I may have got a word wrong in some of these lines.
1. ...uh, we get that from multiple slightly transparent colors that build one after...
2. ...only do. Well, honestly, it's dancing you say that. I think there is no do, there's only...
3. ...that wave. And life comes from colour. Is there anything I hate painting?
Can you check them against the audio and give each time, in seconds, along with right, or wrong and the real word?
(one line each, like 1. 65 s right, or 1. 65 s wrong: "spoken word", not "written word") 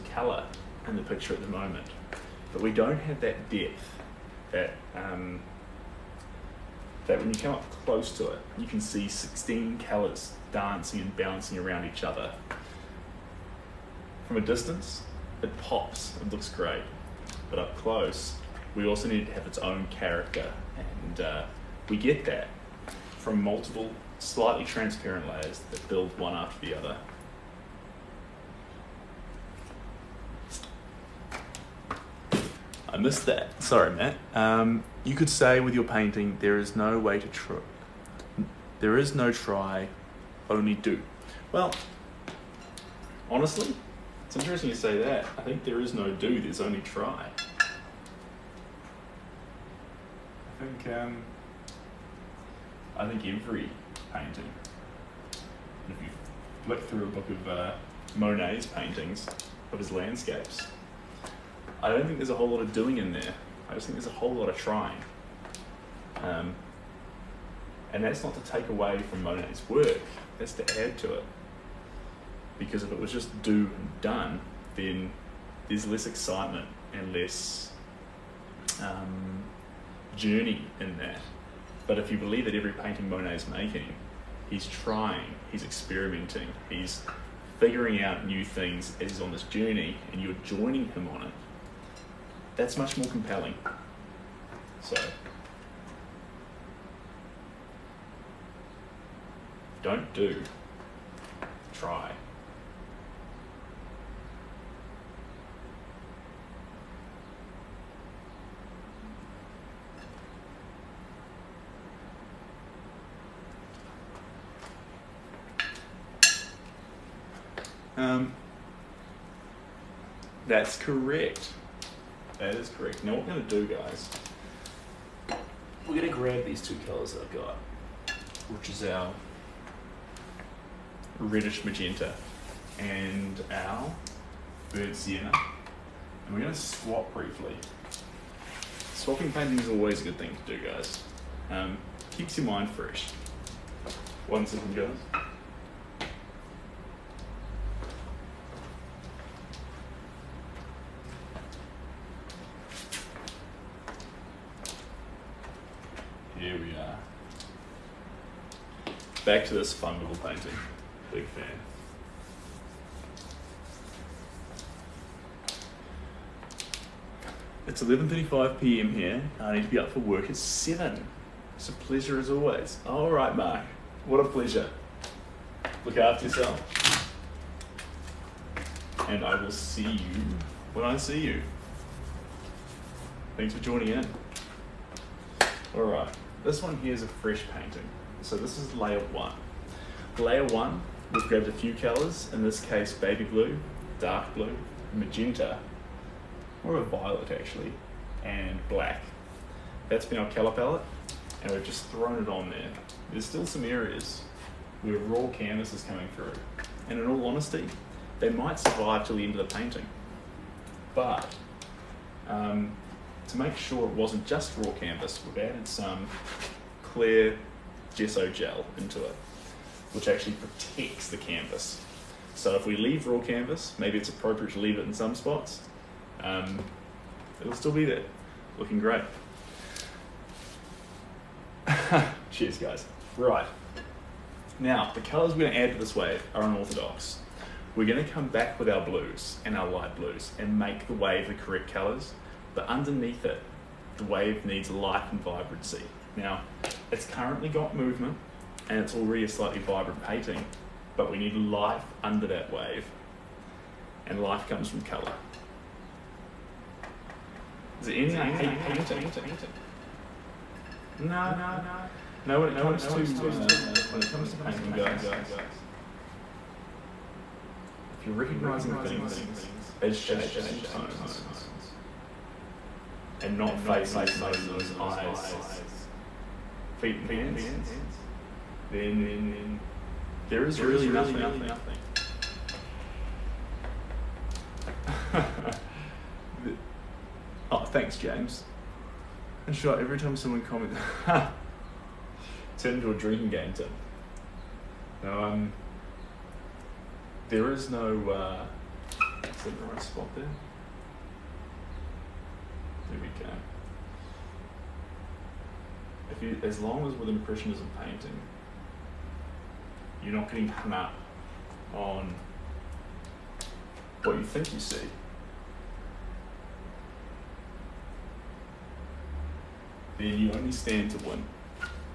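1. 21 s wrong: "layers", not "colors"
2. 40 s wrong: "interesting", not "dancing"
3. 252 s right.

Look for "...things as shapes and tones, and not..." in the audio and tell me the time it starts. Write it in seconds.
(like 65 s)
268 s.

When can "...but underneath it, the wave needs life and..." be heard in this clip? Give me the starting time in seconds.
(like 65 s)
242 s.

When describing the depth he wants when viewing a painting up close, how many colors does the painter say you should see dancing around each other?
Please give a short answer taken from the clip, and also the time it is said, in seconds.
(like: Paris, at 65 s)
16, at 9 s.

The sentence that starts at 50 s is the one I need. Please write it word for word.
I think um, I think, every painting.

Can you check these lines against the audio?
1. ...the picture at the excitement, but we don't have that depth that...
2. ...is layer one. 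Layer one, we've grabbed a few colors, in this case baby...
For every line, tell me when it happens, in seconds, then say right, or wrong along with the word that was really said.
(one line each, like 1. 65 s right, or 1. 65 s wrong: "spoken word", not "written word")
1. 0 s wrong: "moment", not "excitement"
2. 188 s right.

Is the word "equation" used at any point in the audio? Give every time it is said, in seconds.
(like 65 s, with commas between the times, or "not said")
not said.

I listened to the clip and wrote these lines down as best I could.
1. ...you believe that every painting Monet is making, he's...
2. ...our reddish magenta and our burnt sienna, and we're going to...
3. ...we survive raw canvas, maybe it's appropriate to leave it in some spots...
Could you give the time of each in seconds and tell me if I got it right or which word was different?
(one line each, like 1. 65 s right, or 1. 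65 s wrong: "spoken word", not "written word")
1. 82 s right
2. 128 s right
3. 222 s wrong: "leave", not "survive".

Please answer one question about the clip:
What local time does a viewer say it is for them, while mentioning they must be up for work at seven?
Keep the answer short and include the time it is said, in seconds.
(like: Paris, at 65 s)
11:35 p.m., at 167 s.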